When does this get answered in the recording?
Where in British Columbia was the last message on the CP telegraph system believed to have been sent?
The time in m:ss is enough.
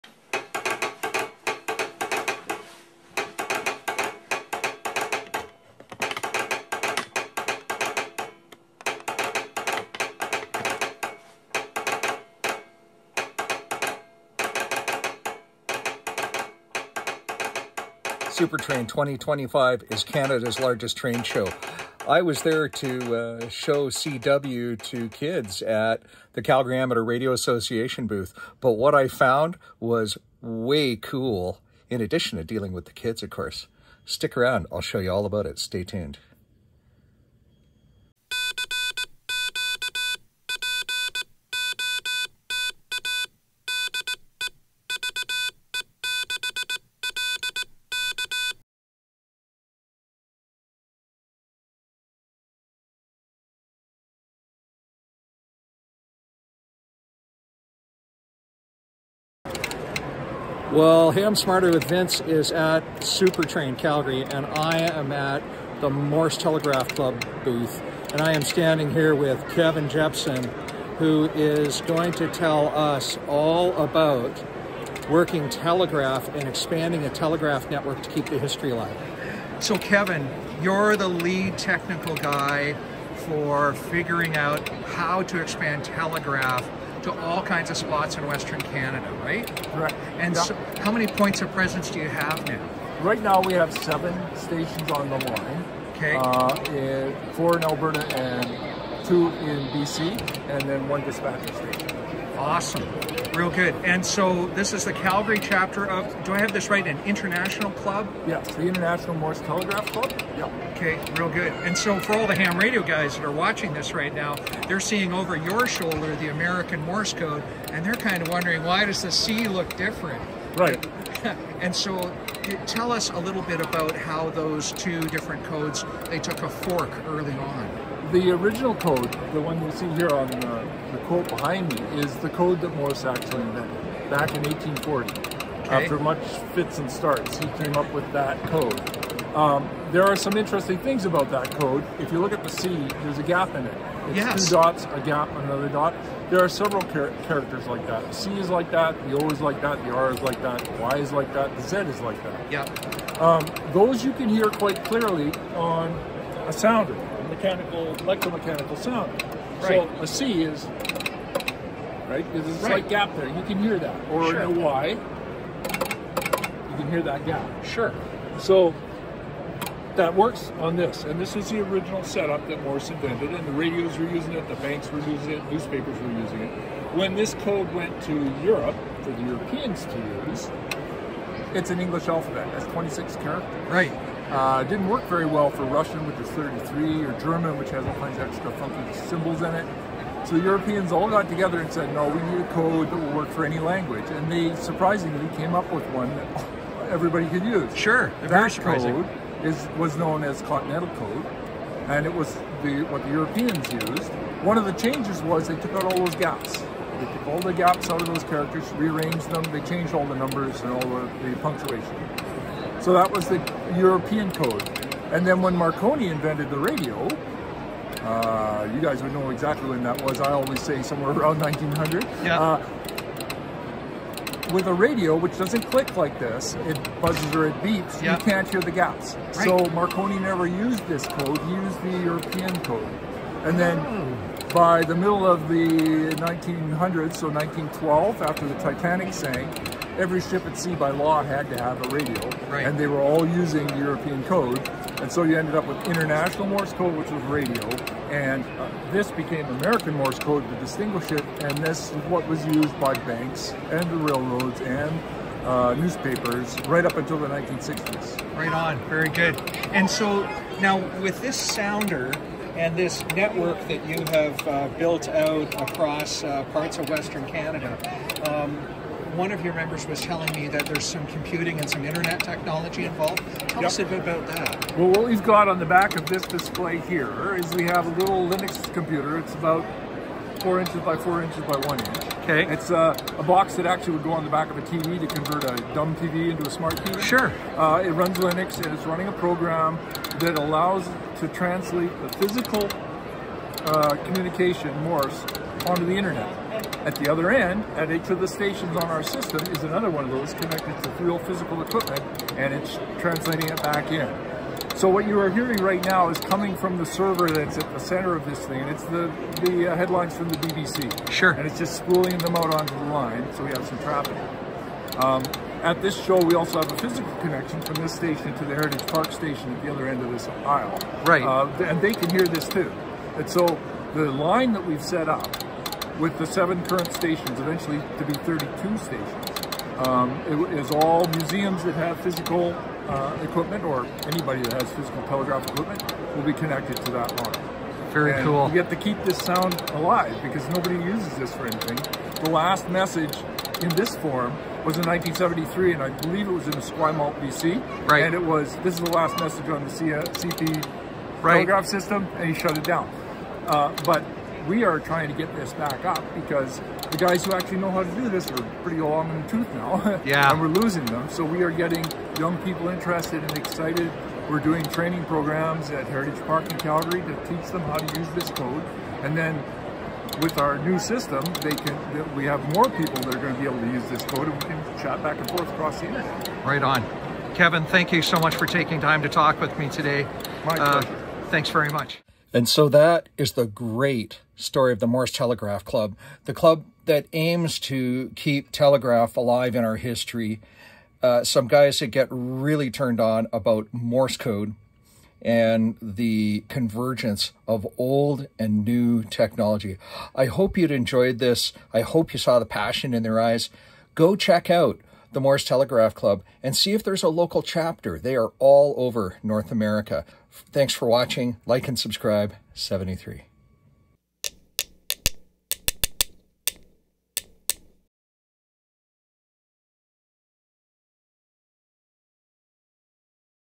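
5:46.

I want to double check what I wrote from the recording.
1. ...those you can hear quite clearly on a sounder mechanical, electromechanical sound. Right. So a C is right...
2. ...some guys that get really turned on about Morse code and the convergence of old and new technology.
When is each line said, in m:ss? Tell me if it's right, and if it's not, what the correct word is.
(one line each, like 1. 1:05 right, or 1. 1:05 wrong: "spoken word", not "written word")
1. 2:33 right
2. 6:31 right.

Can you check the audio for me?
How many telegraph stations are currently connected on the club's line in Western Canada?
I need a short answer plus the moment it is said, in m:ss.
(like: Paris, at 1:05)
7, at 1:33.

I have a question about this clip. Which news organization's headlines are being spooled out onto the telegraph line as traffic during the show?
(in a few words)
BBC.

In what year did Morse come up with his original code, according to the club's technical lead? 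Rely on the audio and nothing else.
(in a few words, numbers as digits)
1840.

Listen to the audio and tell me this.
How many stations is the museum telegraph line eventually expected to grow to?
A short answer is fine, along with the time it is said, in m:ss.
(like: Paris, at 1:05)
32, at 5:28.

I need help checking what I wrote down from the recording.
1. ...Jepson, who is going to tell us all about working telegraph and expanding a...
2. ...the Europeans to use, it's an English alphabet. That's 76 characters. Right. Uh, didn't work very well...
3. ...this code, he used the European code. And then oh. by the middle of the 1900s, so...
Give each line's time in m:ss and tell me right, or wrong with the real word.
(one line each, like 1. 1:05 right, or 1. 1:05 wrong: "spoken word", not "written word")
1. 1:09 right
2. 2:59 wrong: "26", not "76"
3. 3:50 right.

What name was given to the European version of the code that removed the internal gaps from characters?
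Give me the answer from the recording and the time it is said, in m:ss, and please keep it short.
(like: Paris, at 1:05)
Continental Code, at 3:20.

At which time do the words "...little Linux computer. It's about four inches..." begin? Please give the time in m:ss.
4:38.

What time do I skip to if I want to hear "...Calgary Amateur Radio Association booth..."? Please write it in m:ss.
0:26.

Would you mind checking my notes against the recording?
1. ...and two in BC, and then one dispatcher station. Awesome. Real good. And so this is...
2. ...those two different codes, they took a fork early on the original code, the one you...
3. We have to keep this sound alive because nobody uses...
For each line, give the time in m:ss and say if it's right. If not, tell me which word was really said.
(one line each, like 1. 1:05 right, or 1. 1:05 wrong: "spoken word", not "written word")
1. 1:38 right
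2. 2:04 right
3. 5:38 right.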